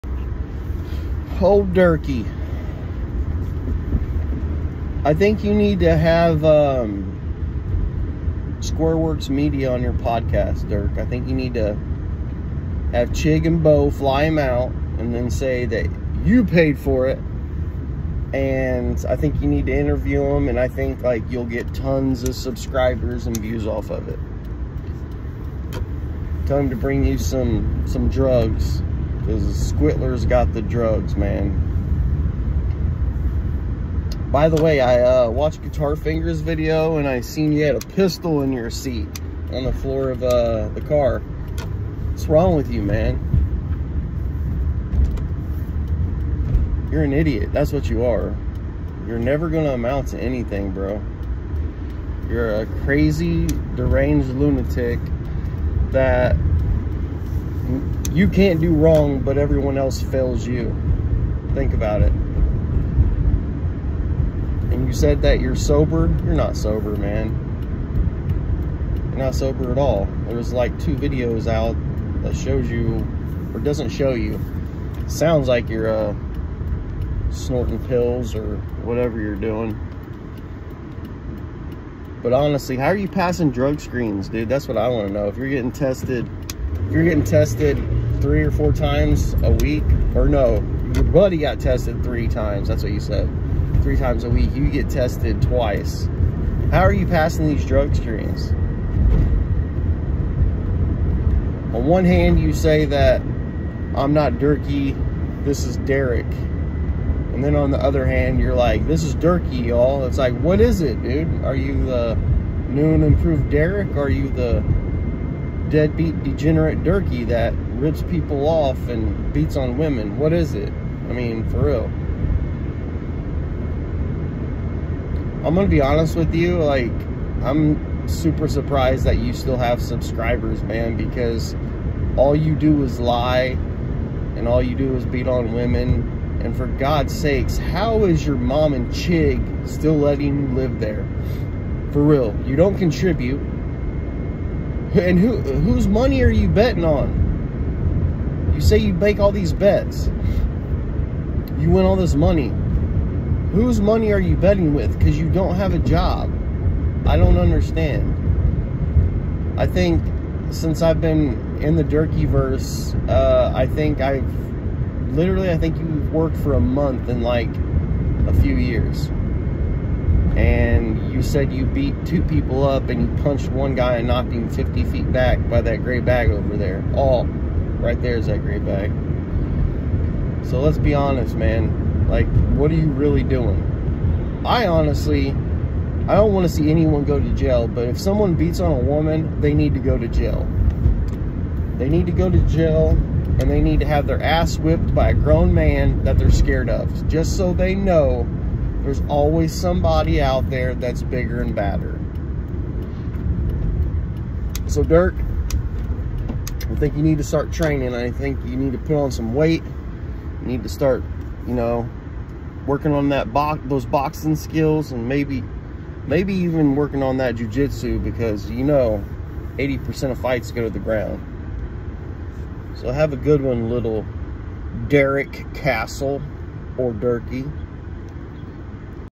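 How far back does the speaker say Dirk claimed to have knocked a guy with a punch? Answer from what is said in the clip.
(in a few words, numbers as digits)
50 feet.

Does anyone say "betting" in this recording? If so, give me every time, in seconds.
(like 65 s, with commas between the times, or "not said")
146 s, 154 s.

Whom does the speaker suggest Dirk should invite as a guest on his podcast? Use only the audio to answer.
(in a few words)
Squareworks Media.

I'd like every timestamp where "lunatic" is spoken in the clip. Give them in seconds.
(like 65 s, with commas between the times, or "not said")
54 s.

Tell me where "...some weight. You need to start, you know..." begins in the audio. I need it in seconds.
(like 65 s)
209 s.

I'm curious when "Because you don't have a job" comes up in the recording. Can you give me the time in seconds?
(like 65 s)
154 s.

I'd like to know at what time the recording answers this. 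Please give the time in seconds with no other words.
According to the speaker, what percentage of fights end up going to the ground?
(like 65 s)
219 s.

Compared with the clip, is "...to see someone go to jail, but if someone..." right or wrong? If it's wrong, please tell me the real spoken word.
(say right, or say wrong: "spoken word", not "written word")
wrong: "anyone", not "someone".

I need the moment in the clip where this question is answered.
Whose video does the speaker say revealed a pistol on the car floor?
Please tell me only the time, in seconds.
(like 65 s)
35 s.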